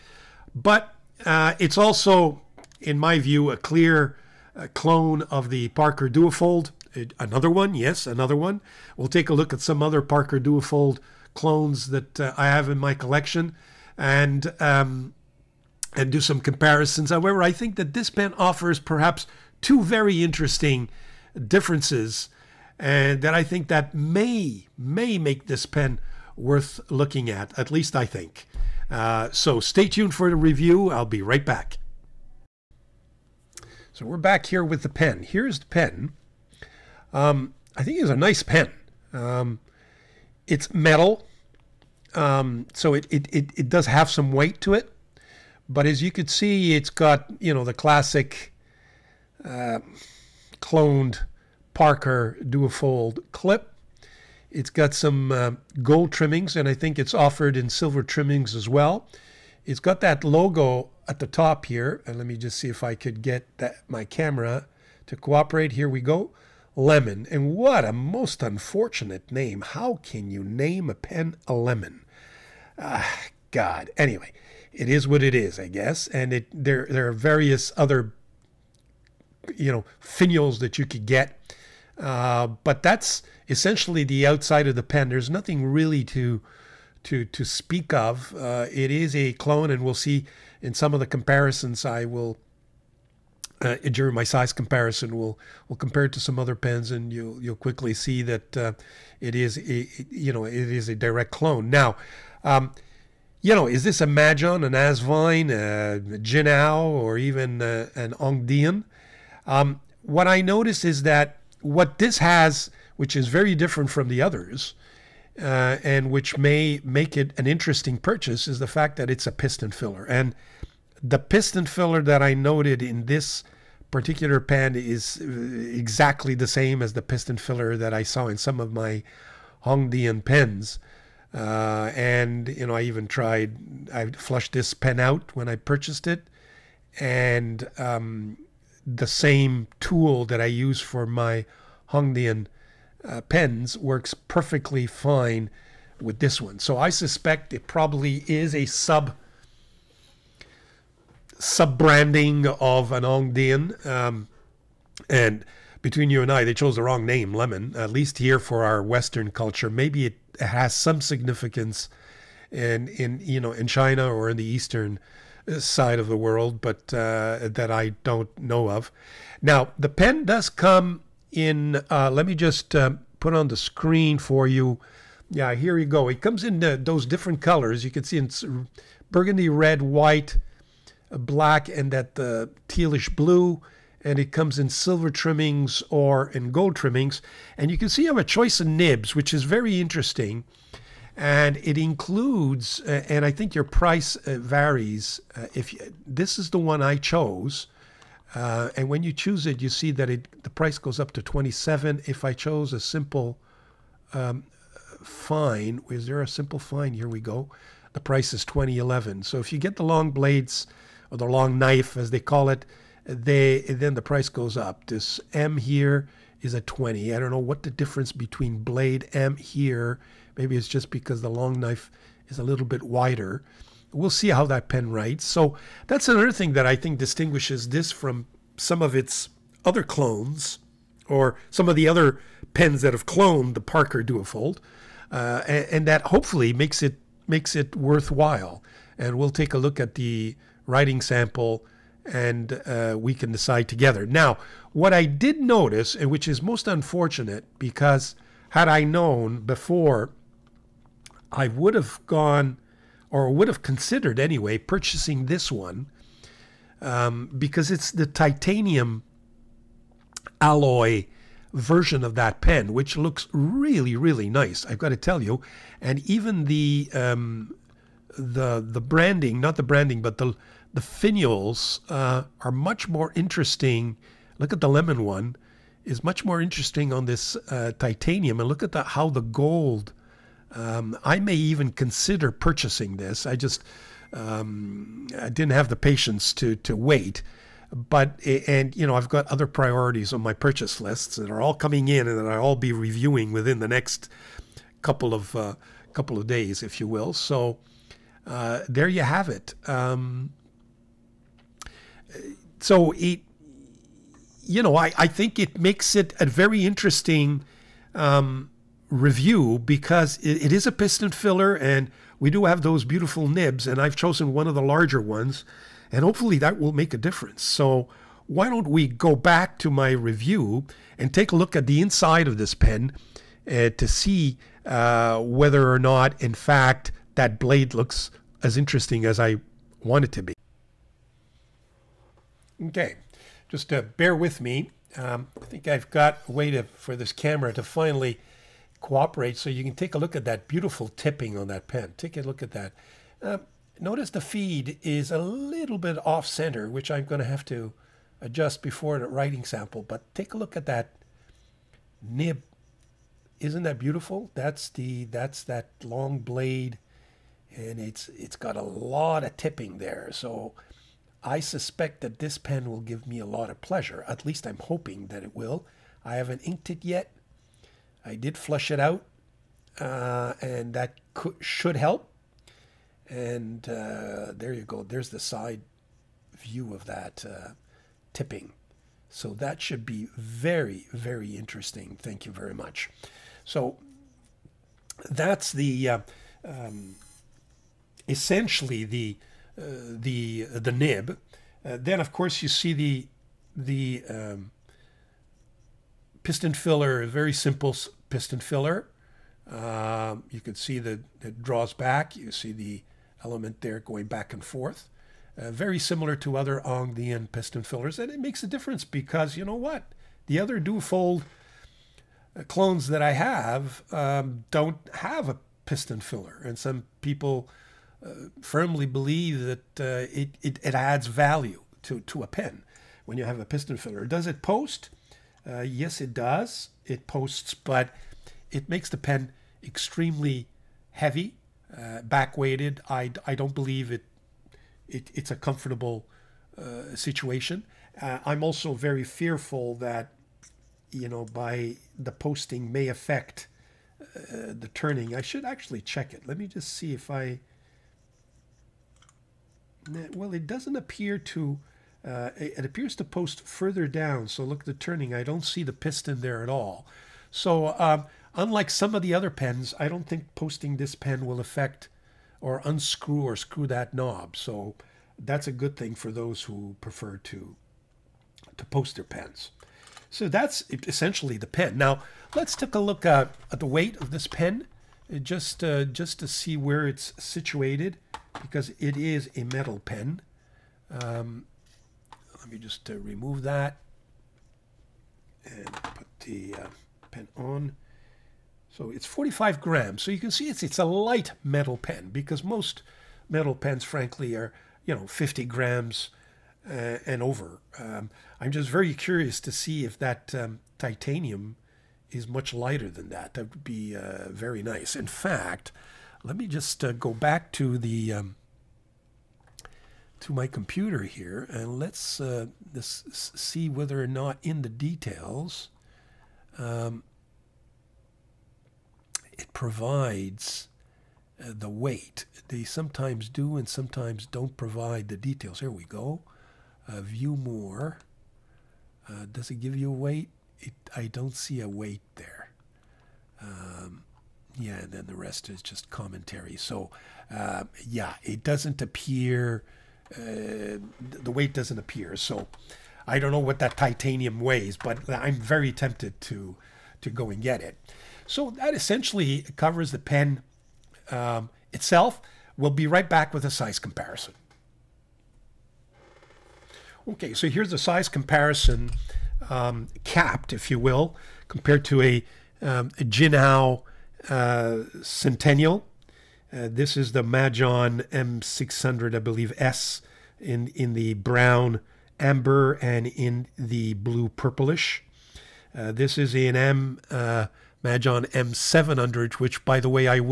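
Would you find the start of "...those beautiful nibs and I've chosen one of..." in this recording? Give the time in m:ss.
5:12.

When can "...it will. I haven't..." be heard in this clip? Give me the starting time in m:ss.
6:05.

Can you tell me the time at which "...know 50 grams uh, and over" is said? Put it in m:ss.
8:14.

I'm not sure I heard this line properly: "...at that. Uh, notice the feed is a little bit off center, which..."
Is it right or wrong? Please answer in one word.
right.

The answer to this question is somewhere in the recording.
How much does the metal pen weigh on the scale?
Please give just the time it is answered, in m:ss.
8:09.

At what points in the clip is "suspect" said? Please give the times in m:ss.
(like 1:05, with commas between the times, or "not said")
2:26, 6:01.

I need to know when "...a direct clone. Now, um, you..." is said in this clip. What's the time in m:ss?
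1:40.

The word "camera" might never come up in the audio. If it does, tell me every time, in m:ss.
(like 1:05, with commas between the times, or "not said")
1:04, 5:37.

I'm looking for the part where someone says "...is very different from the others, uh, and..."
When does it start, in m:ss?
1:53.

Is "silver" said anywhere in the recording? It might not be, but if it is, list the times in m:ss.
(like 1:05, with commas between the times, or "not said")
0:57, 3:04.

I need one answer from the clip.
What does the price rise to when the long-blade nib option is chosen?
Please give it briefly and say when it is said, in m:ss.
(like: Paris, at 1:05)
27, at 3:21.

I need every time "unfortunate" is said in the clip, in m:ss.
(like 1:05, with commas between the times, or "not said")
1:08, 4:06.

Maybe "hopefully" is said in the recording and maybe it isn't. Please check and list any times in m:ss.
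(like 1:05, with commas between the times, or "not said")
3:56, 5:16.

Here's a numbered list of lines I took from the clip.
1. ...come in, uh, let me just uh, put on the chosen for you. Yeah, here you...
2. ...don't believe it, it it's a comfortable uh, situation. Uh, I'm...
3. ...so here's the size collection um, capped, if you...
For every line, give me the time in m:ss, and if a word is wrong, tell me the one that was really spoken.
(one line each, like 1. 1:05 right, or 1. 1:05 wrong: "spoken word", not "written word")
1. 2:50 wrong: "screen", not "chosen"
2. 7:13 right
3. 9:17 wrong: "comparison", not "collection".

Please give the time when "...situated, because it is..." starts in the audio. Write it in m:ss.
7:57.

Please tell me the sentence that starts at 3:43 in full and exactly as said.
We'll see how that pen writes.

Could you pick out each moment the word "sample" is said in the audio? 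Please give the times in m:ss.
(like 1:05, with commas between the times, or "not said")
4:01, 5:49.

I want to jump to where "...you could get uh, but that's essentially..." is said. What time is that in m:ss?
1:20.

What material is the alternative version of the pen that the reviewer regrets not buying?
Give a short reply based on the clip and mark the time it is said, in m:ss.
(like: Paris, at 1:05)
Titanium alloy, at 4:18.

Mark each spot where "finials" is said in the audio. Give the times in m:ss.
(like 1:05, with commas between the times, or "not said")
1:19, 4:30.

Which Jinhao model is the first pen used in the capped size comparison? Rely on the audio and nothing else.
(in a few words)
Centennial.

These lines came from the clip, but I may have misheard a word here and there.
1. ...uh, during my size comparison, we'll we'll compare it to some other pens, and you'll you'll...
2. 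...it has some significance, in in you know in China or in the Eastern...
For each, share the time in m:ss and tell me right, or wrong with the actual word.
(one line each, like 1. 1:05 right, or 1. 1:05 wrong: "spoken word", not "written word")
1. 1:33 right
2. 2:40 right.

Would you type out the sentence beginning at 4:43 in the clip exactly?
I just um, I didn't have the patience to to wait.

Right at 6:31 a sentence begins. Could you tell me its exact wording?
Uh, then of course you see the the um, piston filler, a very simple piston filler.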